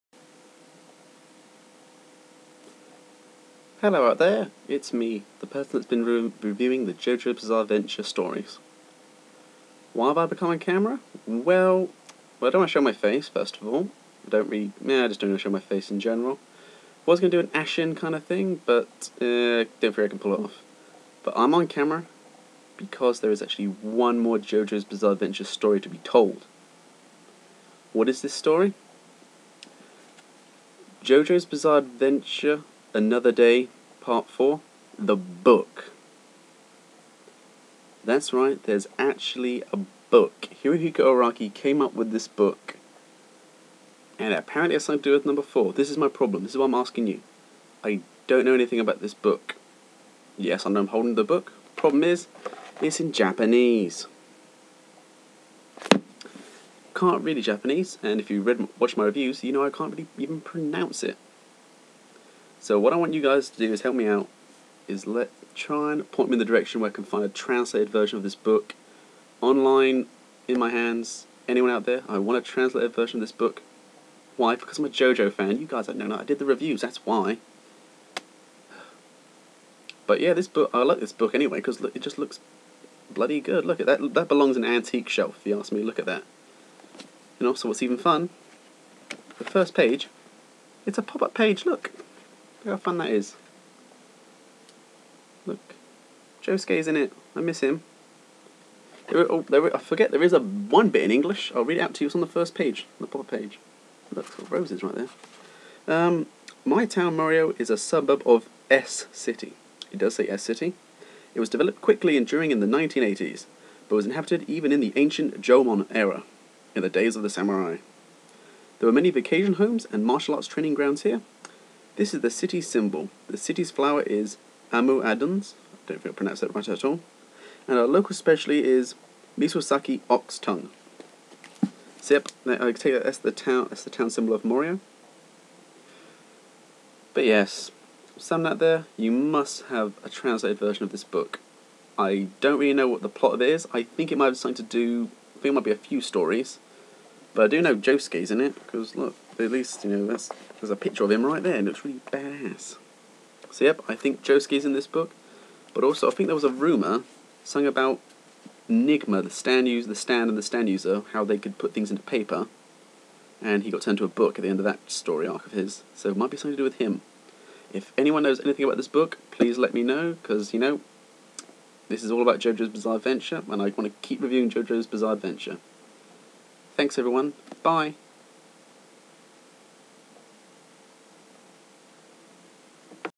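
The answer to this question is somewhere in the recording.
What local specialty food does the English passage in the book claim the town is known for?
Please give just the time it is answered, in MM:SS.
02:09.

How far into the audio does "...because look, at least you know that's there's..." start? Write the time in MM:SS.
02:28.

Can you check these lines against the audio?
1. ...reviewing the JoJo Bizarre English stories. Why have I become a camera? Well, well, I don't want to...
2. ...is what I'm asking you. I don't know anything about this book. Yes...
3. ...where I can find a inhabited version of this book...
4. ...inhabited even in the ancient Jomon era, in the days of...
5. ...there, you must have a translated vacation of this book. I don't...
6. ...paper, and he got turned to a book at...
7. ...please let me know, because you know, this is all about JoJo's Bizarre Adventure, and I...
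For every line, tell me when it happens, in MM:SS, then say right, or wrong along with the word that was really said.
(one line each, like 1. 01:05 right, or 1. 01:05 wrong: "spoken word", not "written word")
1. 00:06 wrong: "Adventure", not "English"
2. 00:46 right
3. 01:06 wrong: "translated", not "inhabited"
4. 01:54 right
5. 02:18 wrong: "version", not "vacation"
6. 02:42 right
7. 02:49 right.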